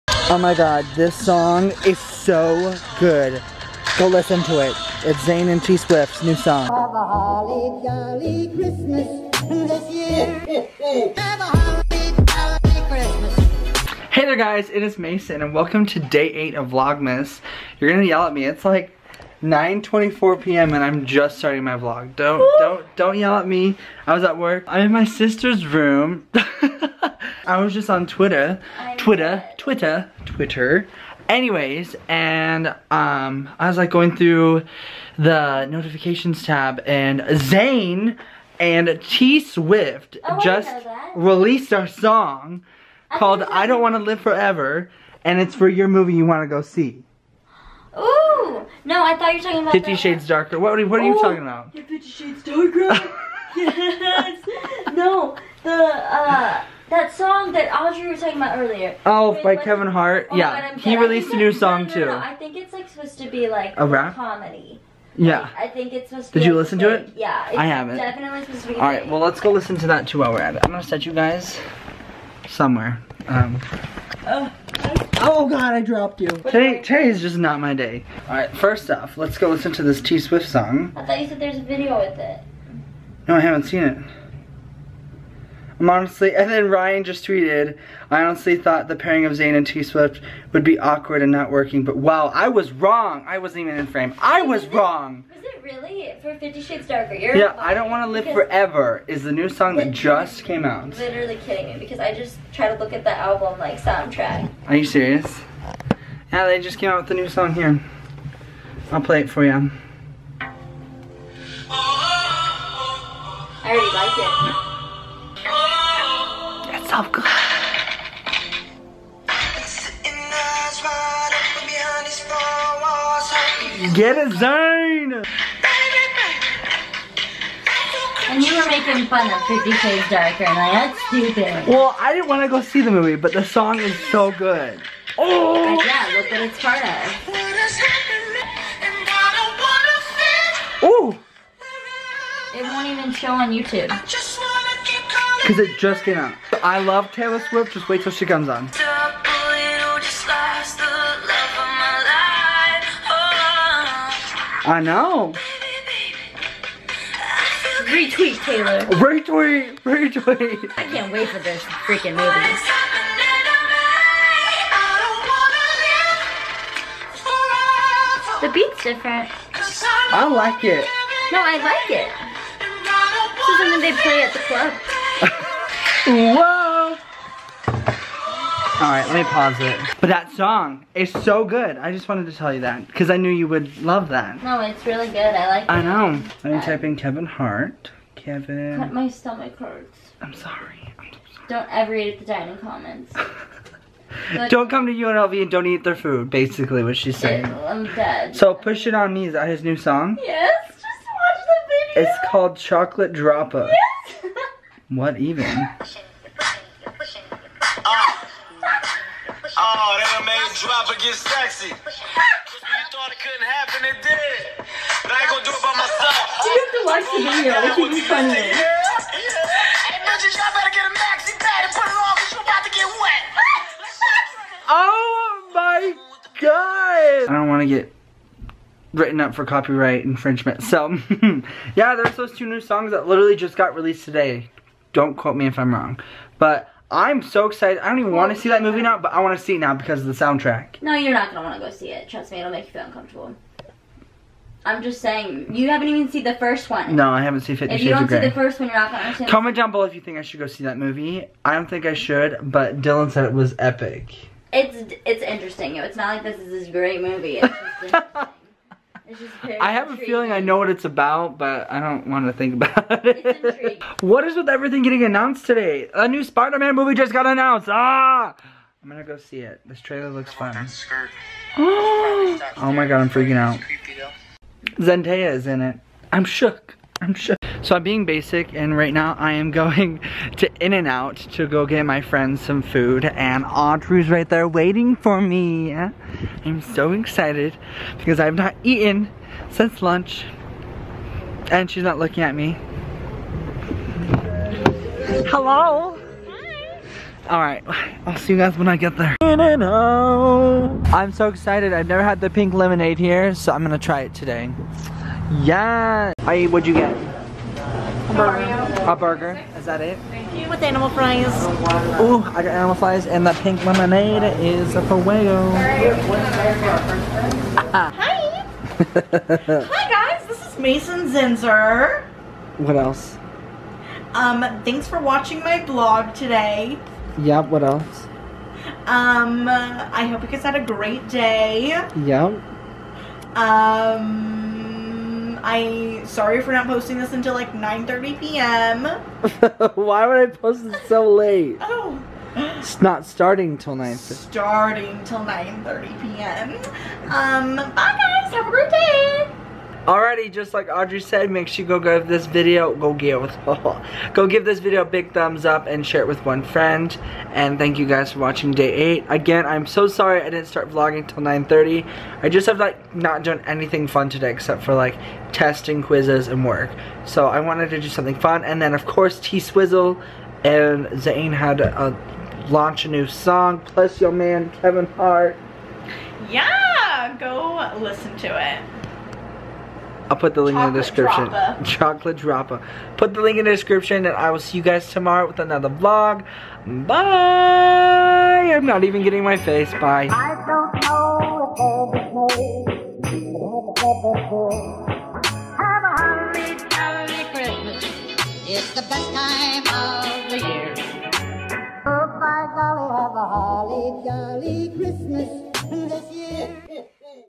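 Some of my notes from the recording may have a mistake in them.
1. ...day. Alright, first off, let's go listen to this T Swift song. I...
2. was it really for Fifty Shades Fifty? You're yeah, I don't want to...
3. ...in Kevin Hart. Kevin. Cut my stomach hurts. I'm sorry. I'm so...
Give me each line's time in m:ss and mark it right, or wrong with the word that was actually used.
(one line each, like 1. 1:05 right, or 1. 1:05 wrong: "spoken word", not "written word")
1. 1:17 right
2. 1:35 wrong: "Darker", not "Fifty"
3. 3:06 right.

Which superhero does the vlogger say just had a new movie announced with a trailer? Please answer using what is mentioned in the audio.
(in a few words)
Spider-Man.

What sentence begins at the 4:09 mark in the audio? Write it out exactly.
Comment down below if you think I should go see that movie.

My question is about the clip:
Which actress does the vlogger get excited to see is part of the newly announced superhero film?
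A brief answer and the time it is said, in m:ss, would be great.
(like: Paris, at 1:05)
Zendaya, at 4:34.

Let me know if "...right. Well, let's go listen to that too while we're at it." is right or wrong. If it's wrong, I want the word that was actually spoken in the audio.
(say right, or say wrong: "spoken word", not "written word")
right.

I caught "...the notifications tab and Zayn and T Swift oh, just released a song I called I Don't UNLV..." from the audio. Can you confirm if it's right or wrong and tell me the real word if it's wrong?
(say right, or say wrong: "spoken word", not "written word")
wrong: "Wanna", not "UNLV".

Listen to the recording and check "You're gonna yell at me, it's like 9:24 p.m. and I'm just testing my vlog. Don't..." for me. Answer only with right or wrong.
wrong.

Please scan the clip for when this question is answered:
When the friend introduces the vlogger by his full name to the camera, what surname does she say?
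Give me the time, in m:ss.
5:21.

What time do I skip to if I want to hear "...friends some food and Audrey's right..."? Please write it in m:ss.
4:42.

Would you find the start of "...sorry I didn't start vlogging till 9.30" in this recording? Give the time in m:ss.
5:59.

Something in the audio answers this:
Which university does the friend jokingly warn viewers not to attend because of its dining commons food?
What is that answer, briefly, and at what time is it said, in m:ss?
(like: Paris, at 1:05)
UNLV, at 3:14.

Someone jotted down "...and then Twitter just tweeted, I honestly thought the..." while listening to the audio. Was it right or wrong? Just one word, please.
wrong.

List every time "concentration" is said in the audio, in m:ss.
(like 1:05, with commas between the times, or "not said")
not said.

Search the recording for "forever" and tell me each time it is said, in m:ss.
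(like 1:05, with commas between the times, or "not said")
0:44, 1:38.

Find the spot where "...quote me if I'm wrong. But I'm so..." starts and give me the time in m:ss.
3:55.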